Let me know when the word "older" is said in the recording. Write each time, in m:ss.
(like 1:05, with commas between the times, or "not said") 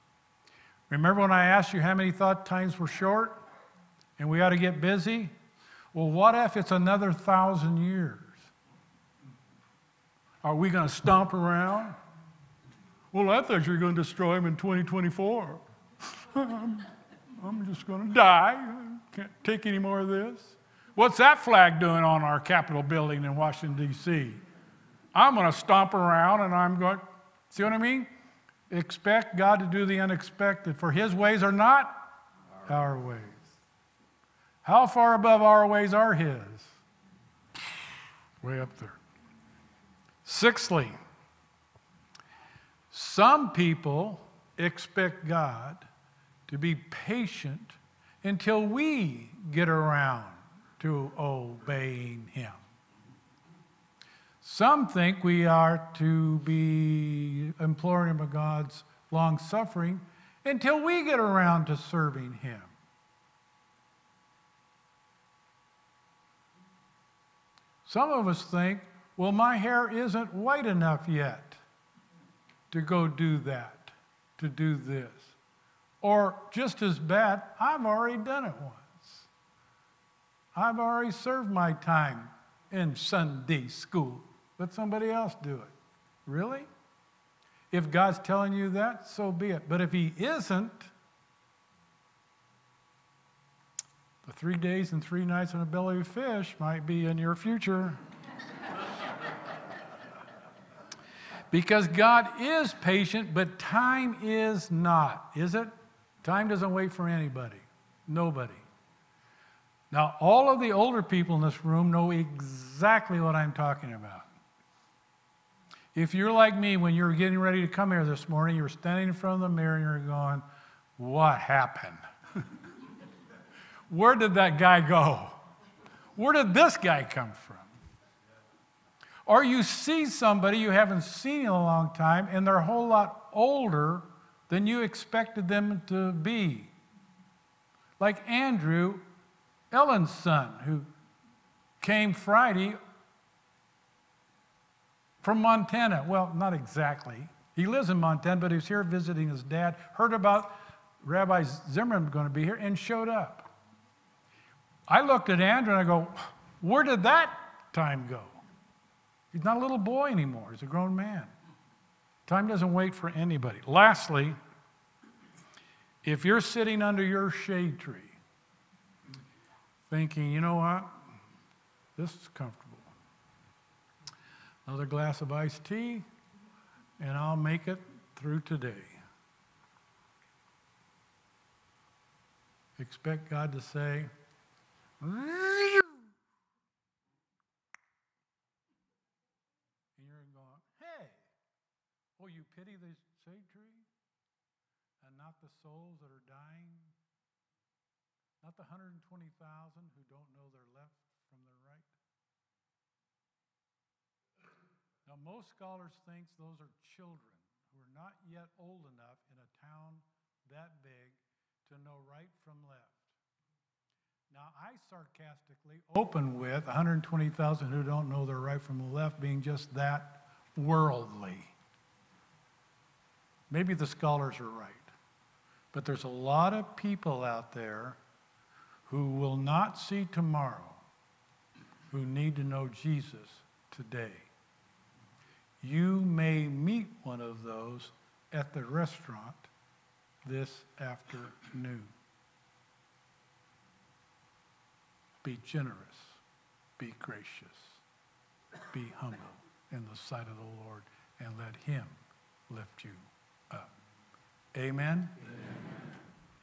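1:50, 2:13.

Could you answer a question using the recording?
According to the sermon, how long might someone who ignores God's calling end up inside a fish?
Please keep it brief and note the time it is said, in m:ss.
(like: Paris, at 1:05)
3 days and 3 nights, at 1:34.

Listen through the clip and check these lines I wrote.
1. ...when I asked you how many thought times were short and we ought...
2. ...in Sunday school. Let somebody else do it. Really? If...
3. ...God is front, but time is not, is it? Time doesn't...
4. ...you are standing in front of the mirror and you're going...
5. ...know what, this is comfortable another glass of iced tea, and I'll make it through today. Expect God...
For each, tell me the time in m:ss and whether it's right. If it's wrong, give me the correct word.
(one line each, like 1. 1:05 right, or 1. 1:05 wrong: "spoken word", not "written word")
1. 0:01 right
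2. 1:22 right
3. 1:41 wrong: "patient", not "front"
4. 1:58 right
5. 2:50 right.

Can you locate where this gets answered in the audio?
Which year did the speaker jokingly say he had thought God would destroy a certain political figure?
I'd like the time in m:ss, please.
0:14.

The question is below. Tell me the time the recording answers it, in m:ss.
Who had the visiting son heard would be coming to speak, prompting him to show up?
2:31.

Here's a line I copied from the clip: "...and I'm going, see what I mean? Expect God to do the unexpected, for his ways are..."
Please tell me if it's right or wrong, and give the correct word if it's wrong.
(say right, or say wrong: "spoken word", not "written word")
right.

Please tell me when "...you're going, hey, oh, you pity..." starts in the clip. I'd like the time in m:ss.
3:10.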